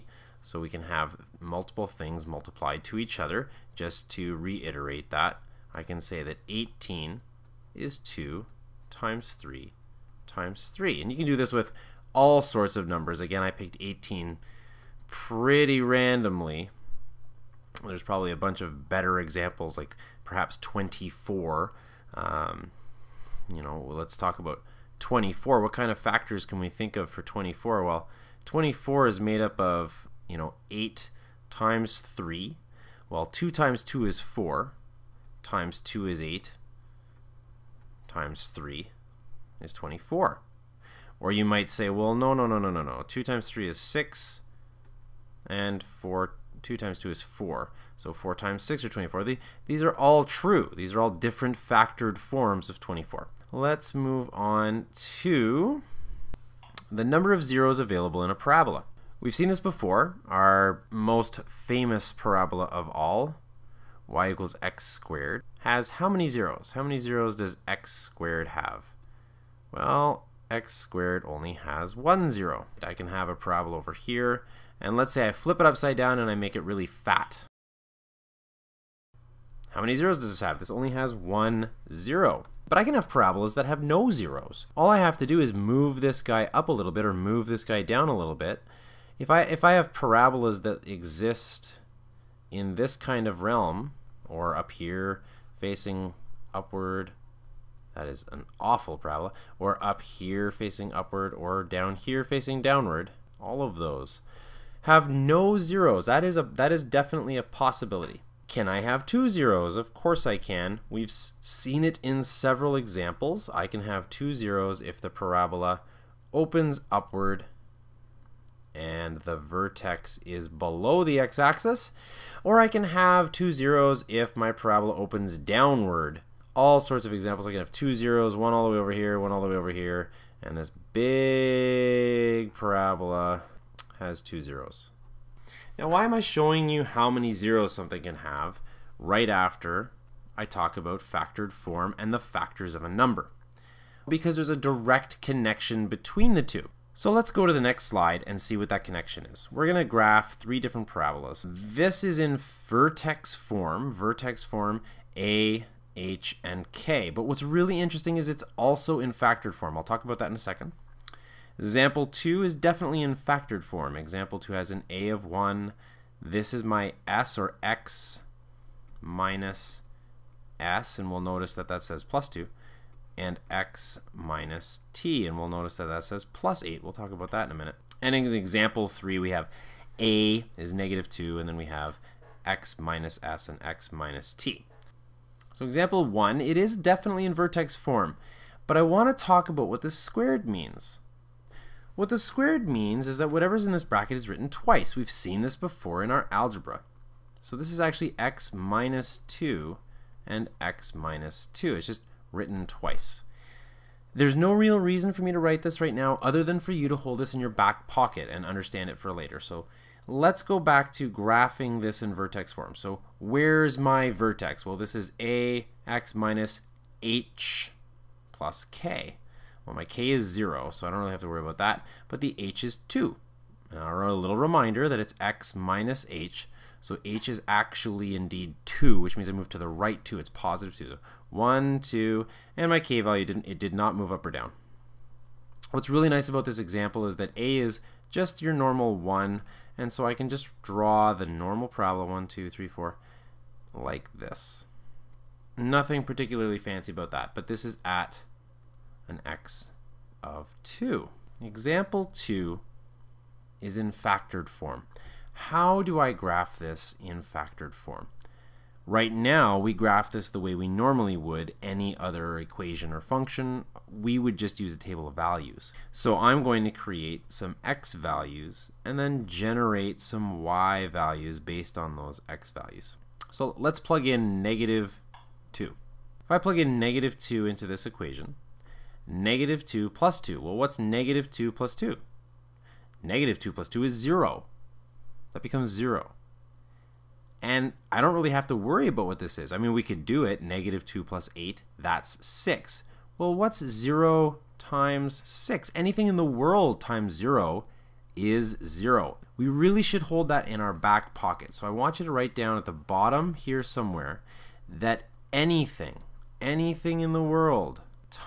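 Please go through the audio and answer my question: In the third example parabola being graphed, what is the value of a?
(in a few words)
-2.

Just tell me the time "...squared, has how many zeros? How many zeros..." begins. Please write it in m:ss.
1:04.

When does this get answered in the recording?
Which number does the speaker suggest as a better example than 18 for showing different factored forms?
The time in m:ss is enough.
0:20.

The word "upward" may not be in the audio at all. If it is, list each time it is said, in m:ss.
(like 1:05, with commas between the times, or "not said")
1:36, 1:40, 1:56.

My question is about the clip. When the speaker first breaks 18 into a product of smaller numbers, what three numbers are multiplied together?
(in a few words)
2 times 3 times 3.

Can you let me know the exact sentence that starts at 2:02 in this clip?
Or I can have two zeros if my parabola opens downward.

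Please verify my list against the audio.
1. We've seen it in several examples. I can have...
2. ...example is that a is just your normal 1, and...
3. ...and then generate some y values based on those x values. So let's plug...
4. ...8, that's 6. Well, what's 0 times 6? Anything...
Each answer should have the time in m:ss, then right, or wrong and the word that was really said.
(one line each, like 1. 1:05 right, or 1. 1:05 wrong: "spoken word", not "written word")
1. 1:50 right
2. 3:56 right
3. 4:28 right
4. 4:51 right.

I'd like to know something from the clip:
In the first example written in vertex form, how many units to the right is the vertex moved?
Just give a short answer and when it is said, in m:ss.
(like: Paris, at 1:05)
2, at 3:49.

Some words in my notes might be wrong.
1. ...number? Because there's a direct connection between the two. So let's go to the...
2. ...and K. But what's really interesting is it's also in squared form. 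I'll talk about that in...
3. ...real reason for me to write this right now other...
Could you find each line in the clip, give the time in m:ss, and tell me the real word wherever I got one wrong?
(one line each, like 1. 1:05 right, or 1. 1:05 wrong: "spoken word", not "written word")
1. 2:22 right
2. 2:36 wrong: "factored", not "squared"
3. 3:24 right.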